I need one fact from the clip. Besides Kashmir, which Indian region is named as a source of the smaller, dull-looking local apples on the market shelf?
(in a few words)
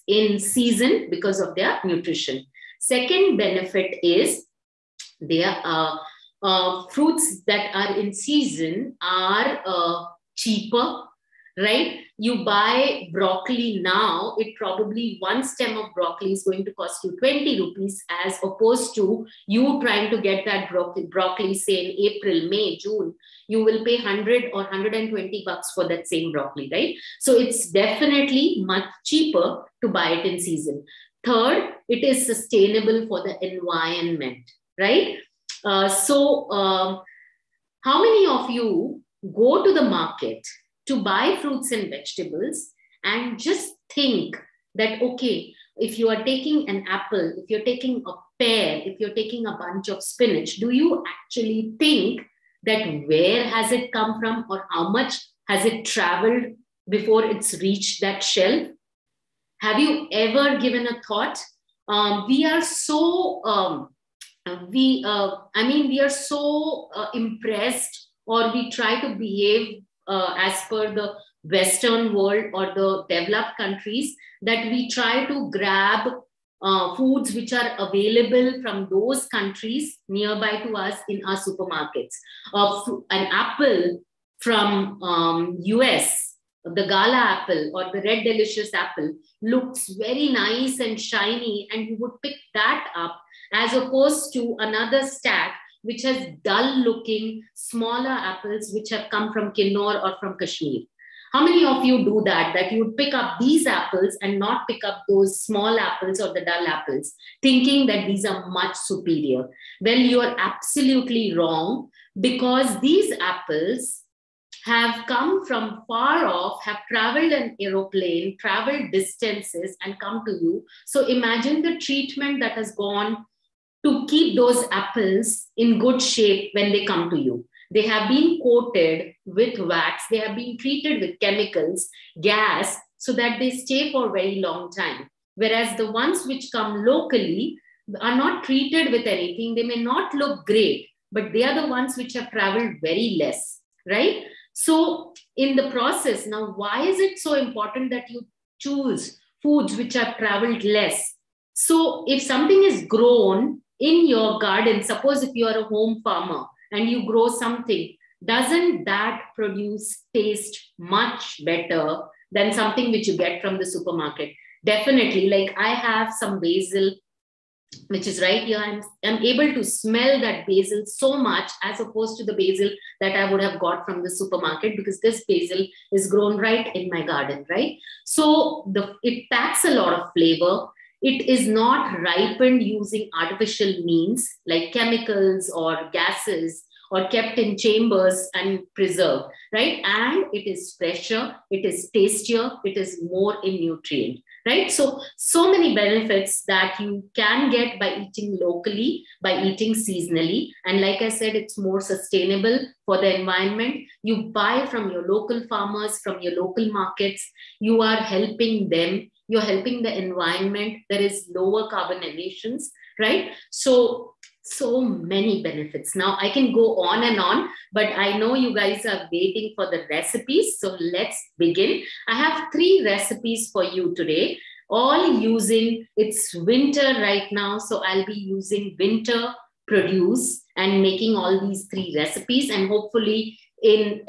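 Kinnaur.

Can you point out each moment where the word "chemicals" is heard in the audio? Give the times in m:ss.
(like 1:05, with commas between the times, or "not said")
2:11, 3:04.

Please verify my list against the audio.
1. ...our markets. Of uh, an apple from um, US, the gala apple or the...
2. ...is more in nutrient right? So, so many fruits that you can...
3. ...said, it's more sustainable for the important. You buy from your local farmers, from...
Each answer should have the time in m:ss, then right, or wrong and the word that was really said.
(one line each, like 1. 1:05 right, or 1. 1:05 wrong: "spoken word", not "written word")
1. 1:21 wrong: "supermarkets", not "markets"
2. 3:12 wrong: "benefits", not "fruits"
3. 3:21 wrong: "environment", not "important".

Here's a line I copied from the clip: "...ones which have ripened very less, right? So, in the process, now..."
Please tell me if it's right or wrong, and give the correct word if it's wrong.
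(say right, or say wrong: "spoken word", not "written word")
wrong: "traveled", not "ripened".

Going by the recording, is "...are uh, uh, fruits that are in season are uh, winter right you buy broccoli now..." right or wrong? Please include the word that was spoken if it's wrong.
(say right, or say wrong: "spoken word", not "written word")
wrong: "cheaper", not "winter".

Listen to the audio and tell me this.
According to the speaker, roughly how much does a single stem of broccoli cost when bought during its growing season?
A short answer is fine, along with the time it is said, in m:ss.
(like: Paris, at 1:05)
20 rupees, at 0:17.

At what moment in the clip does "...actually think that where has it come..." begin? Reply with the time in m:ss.
0:51.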